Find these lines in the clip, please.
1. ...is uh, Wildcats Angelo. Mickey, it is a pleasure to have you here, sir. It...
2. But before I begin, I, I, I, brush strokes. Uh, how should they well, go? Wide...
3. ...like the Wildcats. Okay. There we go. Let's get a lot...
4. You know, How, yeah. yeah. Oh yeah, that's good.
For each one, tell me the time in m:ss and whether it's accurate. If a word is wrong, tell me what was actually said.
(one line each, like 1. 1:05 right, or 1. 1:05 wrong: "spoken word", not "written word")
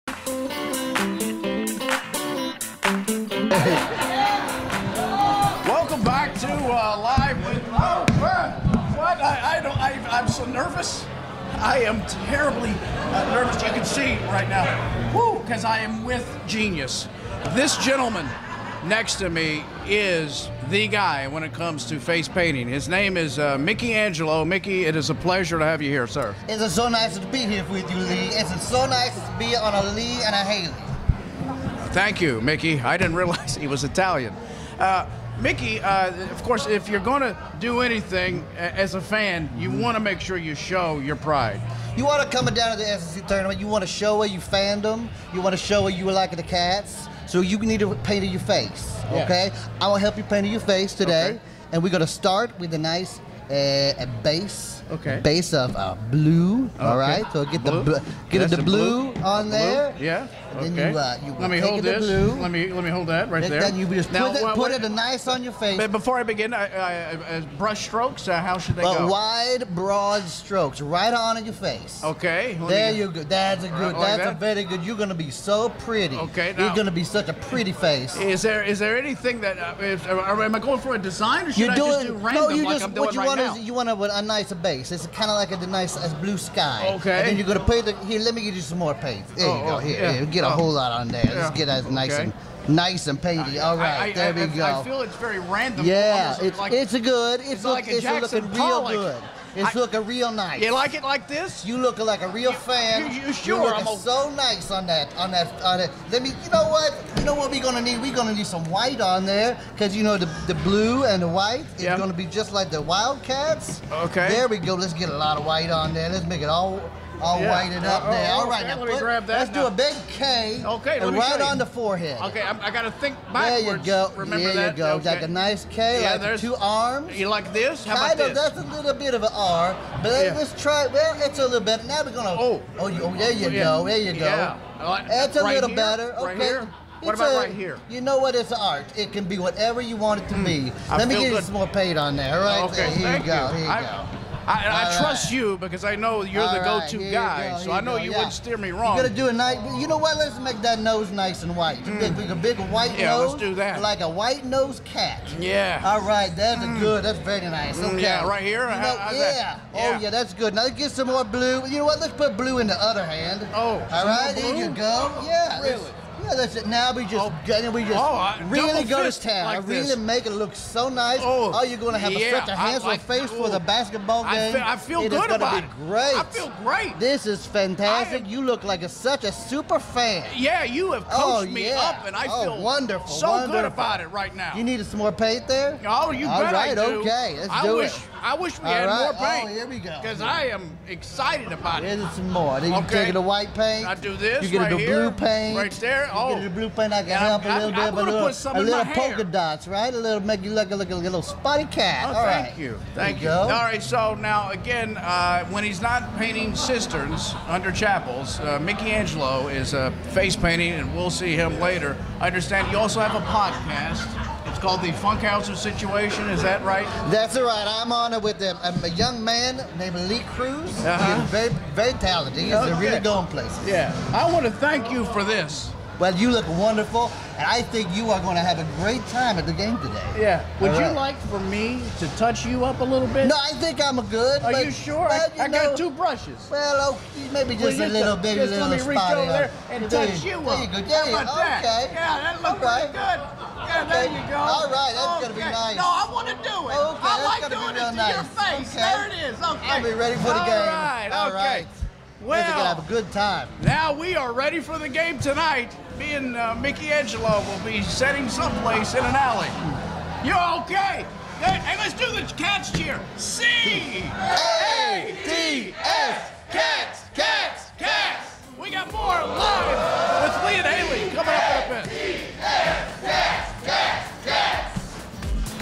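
1. 0:23 wrong: "Mickey", not "Wildcats"
2. 1:05 right
3. 1:52 right
4. 2:38 right.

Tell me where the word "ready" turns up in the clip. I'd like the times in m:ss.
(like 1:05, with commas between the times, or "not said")
4:09, 4:14.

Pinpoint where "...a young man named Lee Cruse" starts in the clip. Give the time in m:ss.
3:38.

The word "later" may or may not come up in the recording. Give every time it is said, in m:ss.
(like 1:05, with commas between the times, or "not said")
3:31.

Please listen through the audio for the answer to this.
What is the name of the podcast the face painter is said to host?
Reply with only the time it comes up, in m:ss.
3:34.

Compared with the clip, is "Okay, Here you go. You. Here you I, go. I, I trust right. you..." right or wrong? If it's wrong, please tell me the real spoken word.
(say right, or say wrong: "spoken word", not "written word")
right.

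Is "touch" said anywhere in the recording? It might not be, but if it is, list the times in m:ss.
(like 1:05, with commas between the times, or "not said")
3:52, 4:00.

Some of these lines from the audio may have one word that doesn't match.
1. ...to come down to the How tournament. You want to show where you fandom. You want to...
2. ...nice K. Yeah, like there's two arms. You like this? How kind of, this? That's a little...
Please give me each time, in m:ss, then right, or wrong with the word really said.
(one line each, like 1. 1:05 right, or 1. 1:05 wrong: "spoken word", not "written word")
1. 0:42 wrong: "SEC", not "How"
2. 2:05 right.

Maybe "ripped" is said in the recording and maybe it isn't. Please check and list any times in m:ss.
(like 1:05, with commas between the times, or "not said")
not said.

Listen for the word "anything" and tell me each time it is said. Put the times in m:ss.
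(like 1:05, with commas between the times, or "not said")
0:37, 1:18.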